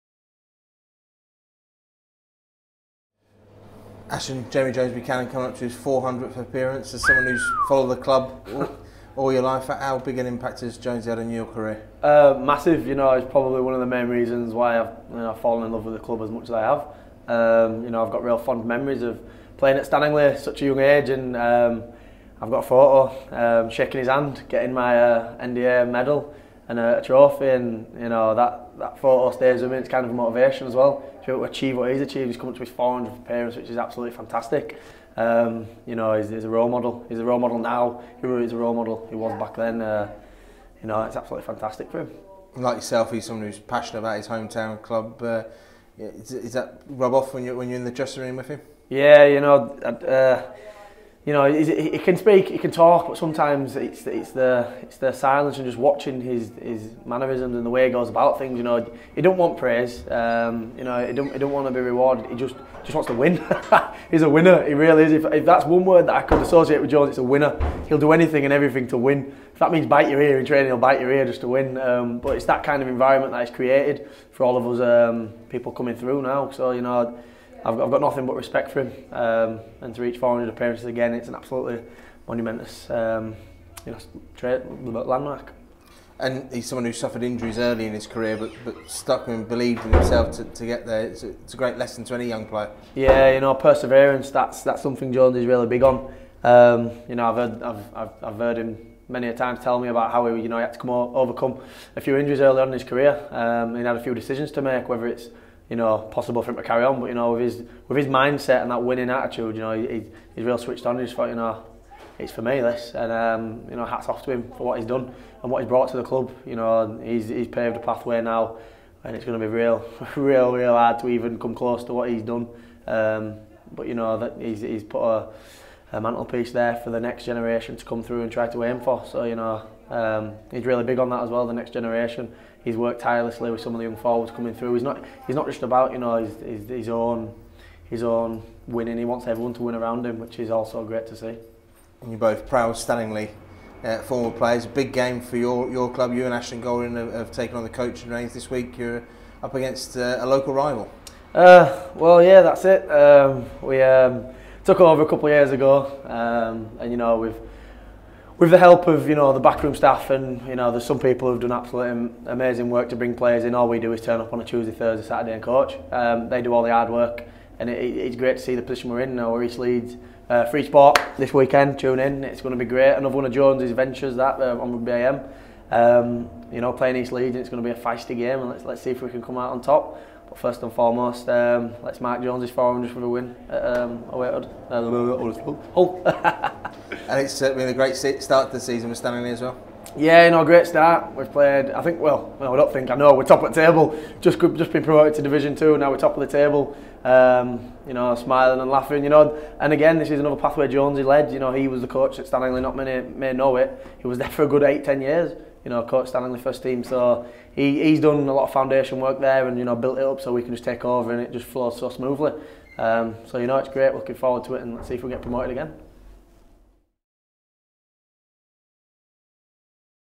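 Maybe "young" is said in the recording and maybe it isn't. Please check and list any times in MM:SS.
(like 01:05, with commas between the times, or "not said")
00:20, 01:32, 02:13.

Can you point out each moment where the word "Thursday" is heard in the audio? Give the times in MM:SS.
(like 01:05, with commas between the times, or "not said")
02:44.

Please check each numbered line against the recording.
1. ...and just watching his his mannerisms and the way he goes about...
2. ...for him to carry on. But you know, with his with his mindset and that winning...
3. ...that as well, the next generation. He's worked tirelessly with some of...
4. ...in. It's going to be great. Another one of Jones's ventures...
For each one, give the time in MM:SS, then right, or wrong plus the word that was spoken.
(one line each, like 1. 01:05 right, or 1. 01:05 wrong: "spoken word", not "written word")
1. 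00:55 right
2. 01:46 right
3. 02:11 right
4. 02:51 right.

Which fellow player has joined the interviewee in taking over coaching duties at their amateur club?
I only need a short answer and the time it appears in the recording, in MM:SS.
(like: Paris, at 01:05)
Ashton Golding, at 02:26.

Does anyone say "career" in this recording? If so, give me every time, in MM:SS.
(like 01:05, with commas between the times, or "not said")
00:11, 01:28, 01:42.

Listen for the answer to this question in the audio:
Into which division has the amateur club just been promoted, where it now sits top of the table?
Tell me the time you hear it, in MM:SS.
03:15.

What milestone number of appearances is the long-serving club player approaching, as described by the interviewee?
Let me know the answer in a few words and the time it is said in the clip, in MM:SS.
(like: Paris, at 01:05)
400, at 00:05.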